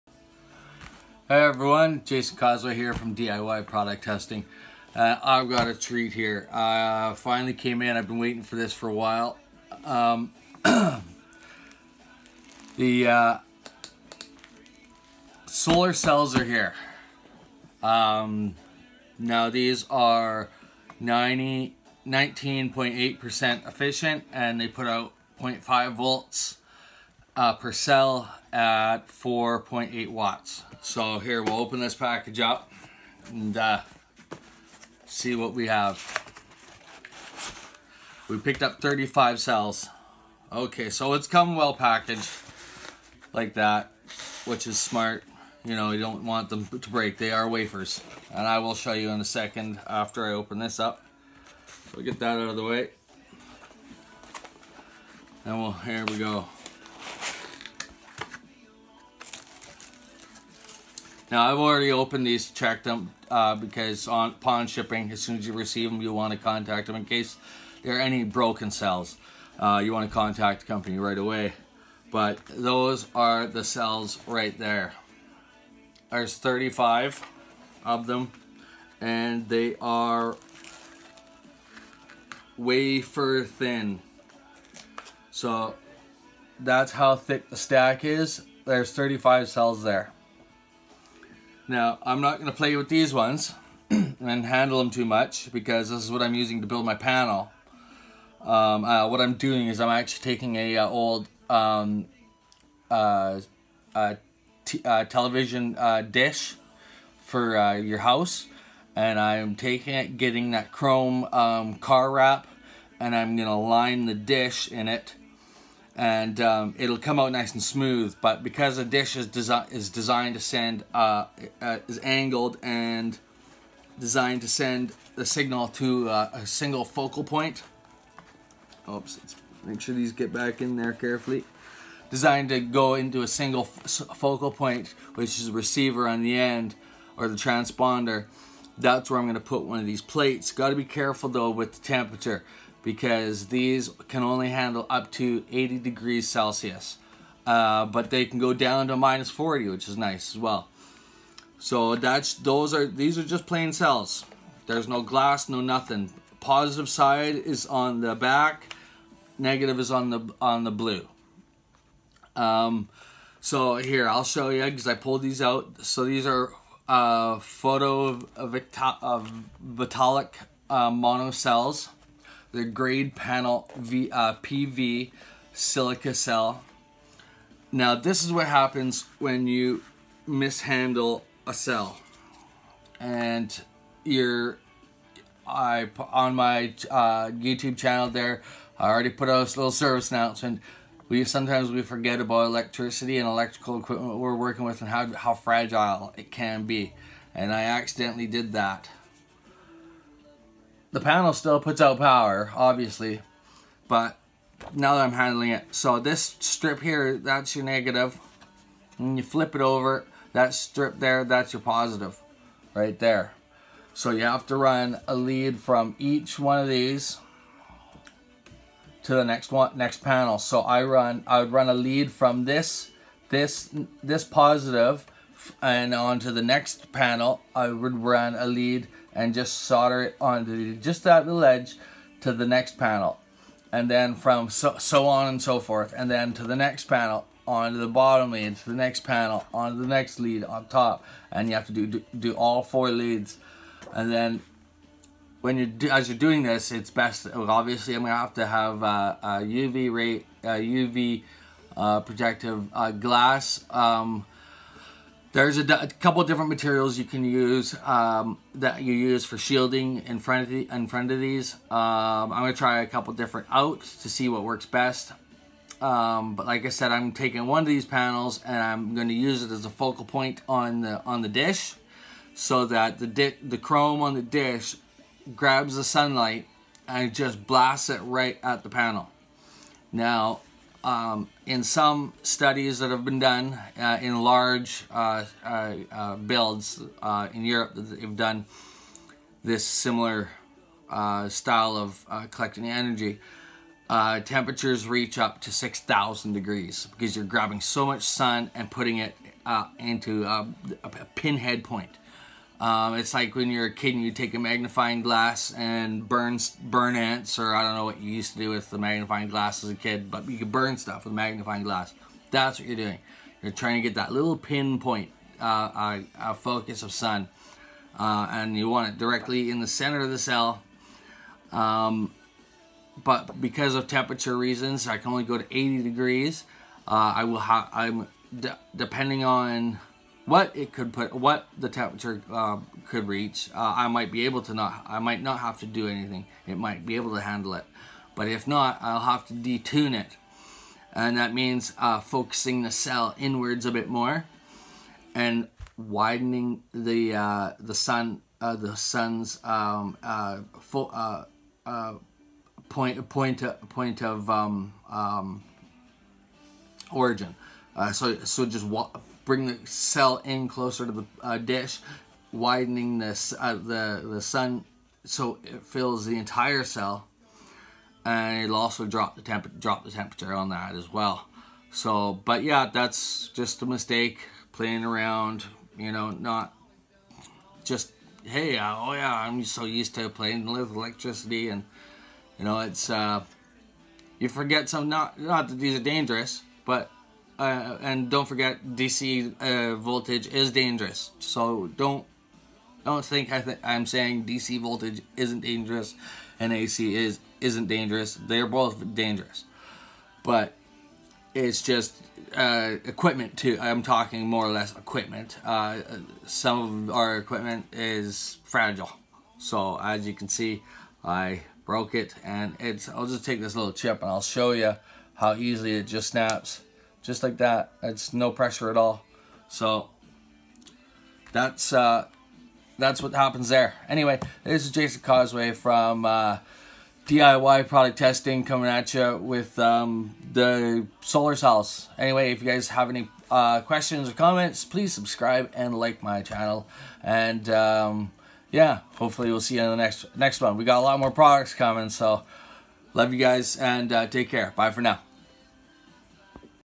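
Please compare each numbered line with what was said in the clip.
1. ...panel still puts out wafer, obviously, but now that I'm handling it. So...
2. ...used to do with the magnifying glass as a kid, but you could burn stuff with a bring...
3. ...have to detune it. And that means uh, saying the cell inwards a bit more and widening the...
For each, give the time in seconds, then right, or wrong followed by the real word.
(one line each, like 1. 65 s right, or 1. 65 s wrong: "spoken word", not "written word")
1. 200 s wrong: "power", not "wafer"
2. 308 s wrong: "magnifying", not "bring"
3. 338 s wrong: "focusing", not "saying".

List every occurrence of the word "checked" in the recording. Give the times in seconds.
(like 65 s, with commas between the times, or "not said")
62 s.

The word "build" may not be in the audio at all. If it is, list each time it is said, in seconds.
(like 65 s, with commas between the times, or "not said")
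96 s, 286 s.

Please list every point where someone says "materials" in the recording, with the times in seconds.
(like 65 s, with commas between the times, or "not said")
256 s.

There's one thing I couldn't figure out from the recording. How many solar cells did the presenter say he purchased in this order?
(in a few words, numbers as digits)
35.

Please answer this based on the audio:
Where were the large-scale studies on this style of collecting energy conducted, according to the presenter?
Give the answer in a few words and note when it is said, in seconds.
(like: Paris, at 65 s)
Europe, at 287 s.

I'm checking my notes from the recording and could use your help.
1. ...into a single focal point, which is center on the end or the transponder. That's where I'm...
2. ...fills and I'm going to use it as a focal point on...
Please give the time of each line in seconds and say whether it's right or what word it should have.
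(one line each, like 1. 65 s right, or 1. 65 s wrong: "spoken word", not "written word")
1. 132 s wrong: "receiver", not "center"
2. 267 s wrong: "panels", not "fills".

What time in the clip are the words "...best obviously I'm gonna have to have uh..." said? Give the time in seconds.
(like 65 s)
246 s.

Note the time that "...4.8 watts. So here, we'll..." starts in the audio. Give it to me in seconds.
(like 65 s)
29 s.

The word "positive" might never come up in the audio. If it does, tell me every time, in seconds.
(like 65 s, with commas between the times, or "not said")
156 s, 211 s, 224 s.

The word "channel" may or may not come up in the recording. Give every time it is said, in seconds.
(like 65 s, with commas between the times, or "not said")
187 s, 436 s.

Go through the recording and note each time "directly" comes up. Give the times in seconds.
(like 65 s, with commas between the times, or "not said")
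318 s.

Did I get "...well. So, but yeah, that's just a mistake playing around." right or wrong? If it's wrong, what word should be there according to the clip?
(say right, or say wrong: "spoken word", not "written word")
right.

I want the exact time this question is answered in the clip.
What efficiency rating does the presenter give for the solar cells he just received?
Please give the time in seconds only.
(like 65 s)
21 s.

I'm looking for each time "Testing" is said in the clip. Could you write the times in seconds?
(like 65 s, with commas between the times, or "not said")
4 s, 427 s.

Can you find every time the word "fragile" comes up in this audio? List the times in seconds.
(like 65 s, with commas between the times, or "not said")
195 s, 408 s.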